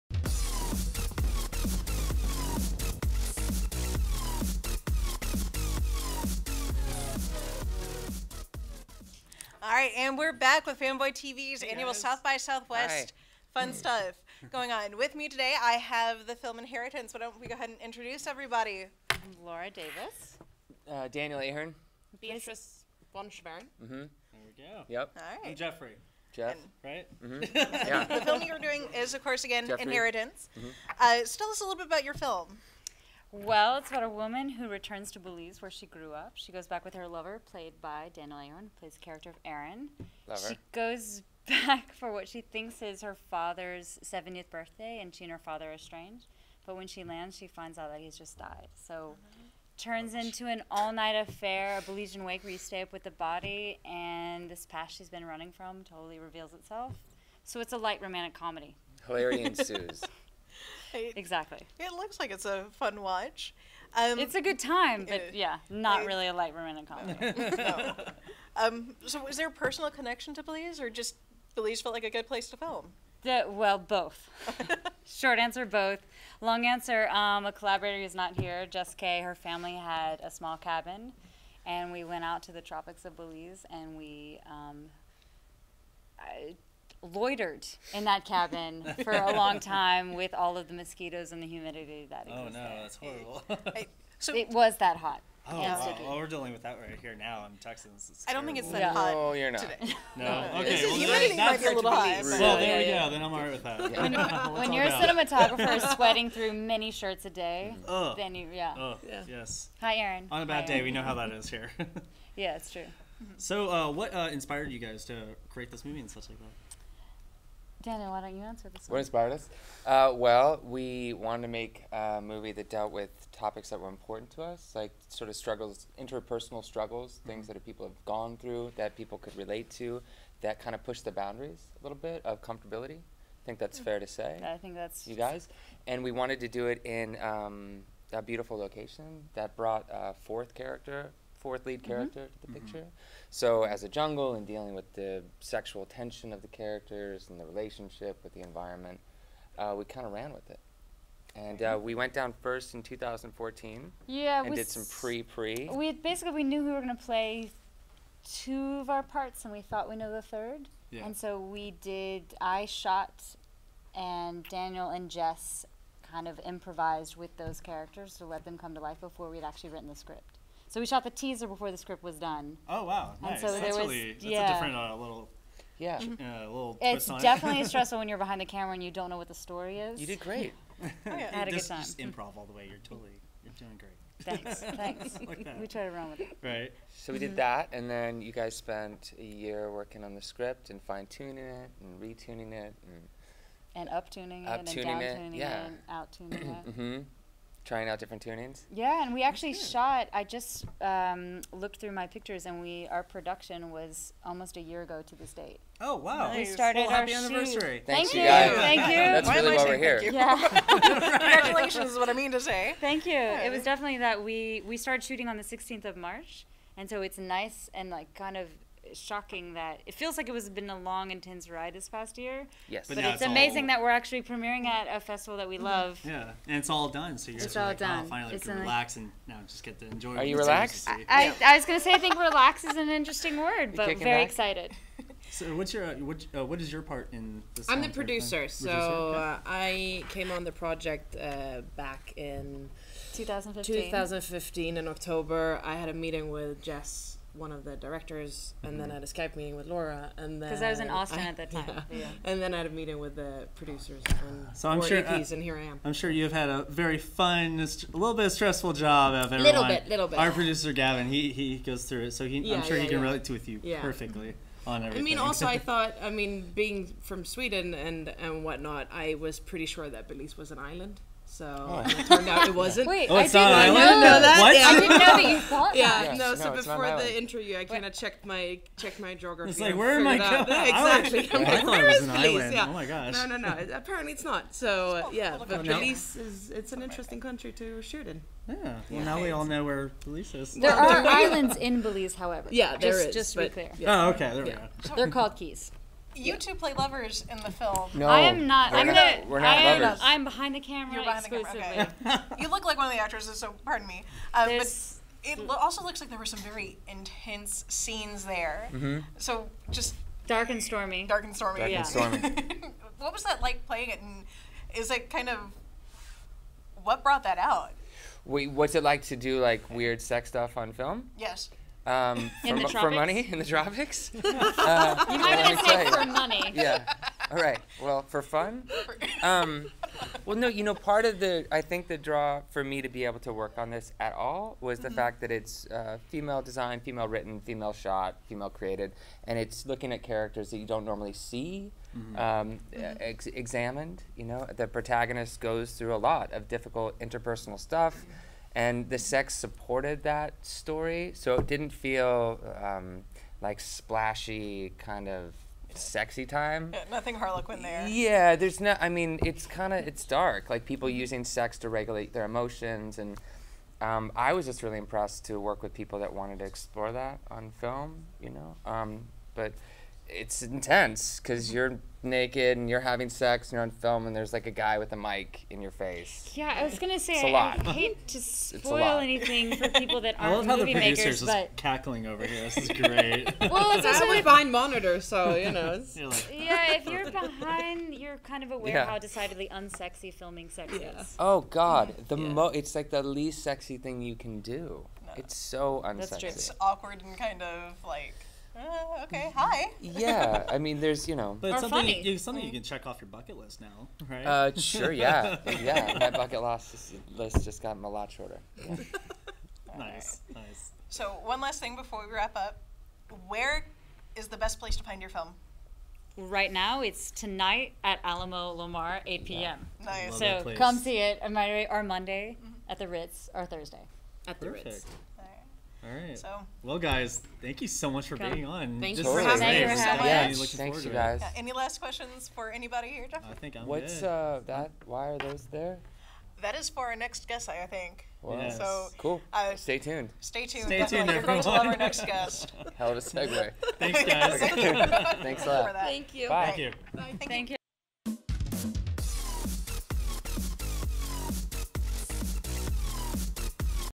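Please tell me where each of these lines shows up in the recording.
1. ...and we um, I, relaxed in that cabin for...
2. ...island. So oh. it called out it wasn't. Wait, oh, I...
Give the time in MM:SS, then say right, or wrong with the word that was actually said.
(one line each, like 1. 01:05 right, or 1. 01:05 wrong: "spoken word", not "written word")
1. 01:23 wrong: "loitered", not "relaxed"
2. 04:30 wrong: "turned", not "called".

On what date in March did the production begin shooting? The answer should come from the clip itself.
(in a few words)
16th.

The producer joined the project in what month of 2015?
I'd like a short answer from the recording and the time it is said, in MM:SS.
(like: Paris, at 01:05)
October, at 04:04.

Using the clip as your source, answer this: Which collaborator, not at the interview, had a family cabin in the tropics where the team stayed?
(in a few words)
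Jess Kaye.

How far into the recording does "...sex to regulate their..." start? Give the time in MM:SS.
06:01.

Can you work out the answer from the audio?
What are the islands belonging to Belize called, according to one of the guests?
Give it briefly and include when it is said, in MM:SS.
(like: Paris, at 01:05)
Keys, at 04:55.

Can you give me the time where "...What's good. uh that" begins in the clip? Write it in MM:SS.
07:13.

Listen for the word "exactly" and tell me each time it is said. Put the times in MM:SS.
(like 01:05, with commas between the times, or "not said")
01:00, 04:40.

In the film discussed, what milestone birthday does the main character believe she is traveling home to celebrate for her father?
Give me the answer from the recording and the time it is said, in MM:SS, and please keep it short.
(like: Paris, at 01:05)
70th, at 00:44.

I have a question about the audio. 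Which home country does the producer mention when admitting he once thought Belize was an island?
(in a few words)
Sweden.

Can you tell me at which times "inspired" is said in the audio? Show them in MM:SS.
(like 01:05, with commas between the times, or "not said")
01:54, 01:58.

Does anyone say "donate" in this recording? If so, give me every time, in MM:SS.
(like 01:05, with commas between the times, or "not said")
not said.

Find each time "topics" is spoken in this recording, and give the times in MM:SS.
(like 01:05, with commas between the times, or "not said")
02:03.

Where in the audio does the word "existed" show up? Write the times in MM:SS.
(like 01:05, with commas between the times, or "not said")
01:32.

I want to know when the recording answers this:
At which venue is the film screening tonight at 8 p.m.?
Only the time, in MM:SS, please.
06:58.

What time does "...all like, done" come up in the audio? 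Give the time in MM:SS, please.
03:47.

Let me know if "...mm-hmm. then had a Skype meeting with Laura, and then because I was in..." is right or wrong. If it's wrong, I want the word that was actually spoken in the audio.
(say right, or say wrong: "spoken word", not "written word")
right.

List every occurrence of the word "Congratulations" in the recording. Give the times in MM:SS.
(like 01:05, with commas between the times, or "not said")
03:30.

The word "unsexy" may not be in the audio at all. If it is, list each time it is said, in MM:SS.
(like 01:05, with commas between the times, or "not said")
06:29, 06:35.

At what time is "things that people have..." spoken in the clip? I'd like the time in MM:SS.
02:07.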